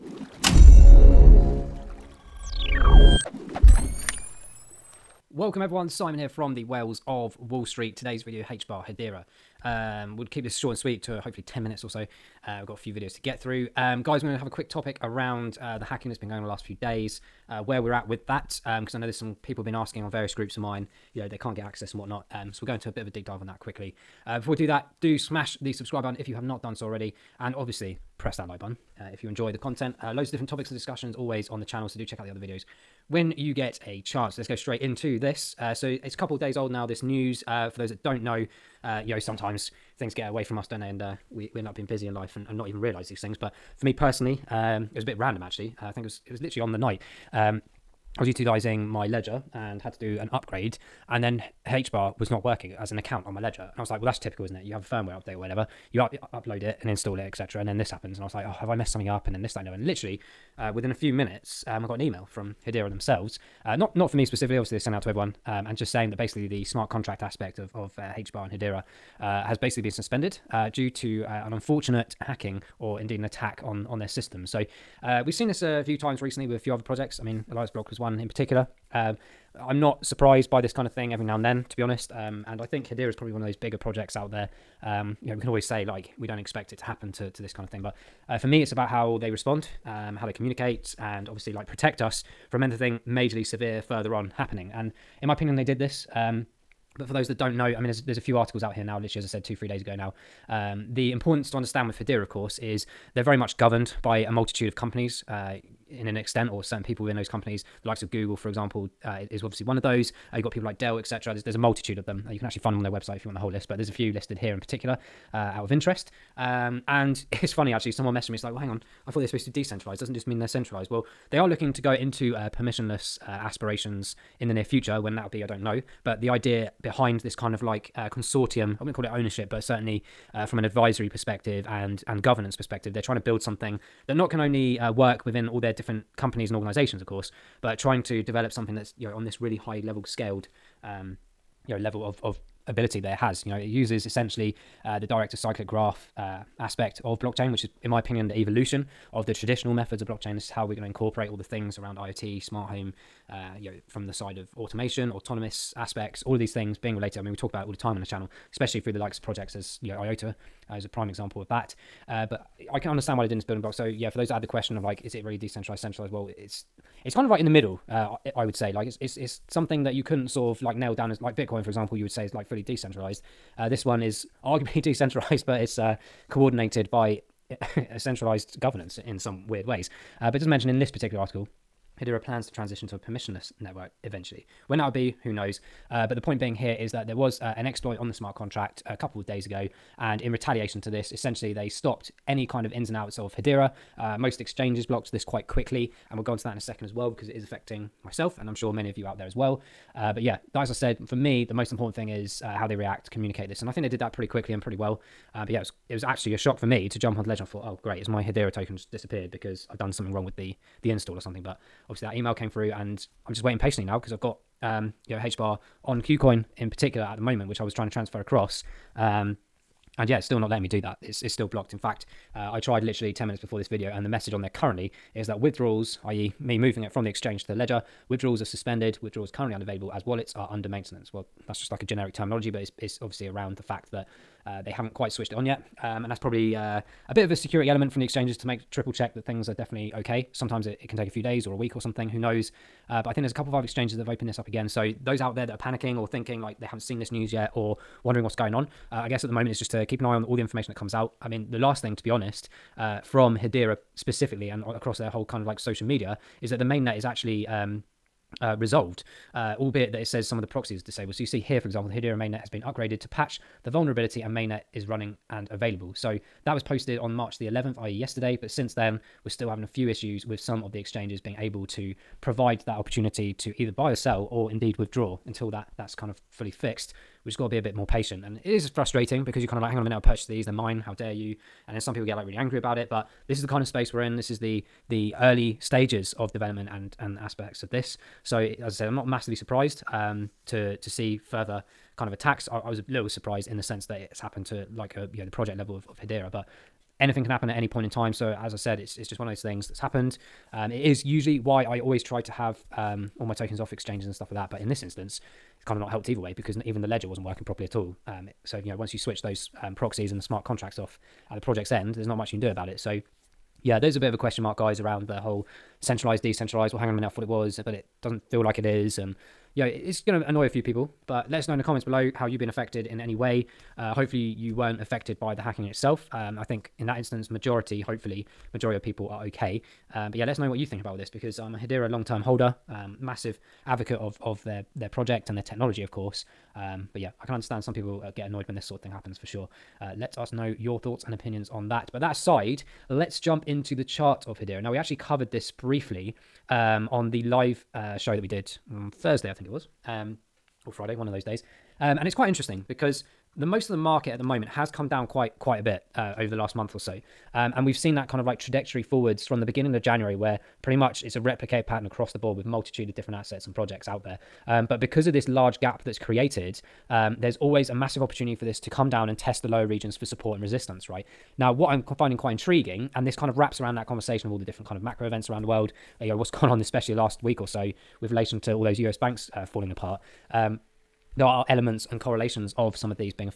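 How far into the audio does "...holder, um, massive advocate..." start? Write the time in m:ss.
5:32.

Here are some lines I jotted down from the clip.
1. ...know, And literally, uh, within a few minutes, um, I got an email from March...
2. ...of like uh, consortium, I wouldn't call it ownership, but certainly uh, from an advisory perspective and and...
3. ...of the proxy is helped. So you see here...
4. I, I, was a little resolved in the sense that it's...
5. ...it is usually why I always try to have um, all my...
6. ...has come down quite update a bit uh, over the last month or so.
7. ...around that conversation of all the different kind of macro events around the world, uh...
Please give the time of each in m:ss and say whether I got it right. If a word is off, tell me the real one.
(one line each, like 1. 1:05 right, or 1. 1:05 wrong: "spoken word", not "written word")
1. 0:59 wrong: "Hedera", not "March"
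2. 2:07 right
3. 4:20 wrong: "disabled", not "helped"
4. 4:52 wrong: "surprised", not "resolved"
5. 5:00 right
6. 5:54 wrong: "quite", not "update"
7. 6:13 right.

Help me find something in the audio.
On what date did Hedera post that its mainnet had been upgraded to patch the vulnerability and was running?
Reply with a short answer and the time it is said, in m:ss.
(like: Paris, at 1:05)
March 11, at 4:27.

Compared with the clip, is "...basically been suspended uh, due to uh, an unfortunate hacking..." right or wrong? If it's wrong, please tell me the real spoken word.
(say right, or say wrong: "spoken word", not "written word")
right.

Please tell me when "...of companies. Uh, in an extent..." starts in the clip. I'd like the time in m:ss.
1:44.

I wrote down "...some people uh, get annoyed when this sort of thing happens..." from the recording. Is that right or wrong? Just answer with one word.
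right.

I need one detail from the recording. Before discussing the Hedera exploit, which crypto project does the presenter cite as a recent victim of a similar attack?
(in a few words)
Elias Block.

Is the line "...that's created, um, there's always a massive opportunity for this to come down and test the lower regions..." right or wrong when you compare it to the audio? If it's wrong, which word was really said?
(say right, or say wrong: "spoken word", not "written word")
right.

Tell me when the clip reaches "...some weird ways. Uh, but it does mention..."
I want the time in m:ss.
2:59.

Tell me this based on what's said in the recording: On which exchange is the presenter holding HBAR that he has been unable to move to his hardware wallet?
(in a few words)
KuCoin.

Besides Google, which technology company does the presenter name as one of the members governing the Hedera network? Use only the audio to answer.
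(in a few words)
Dell.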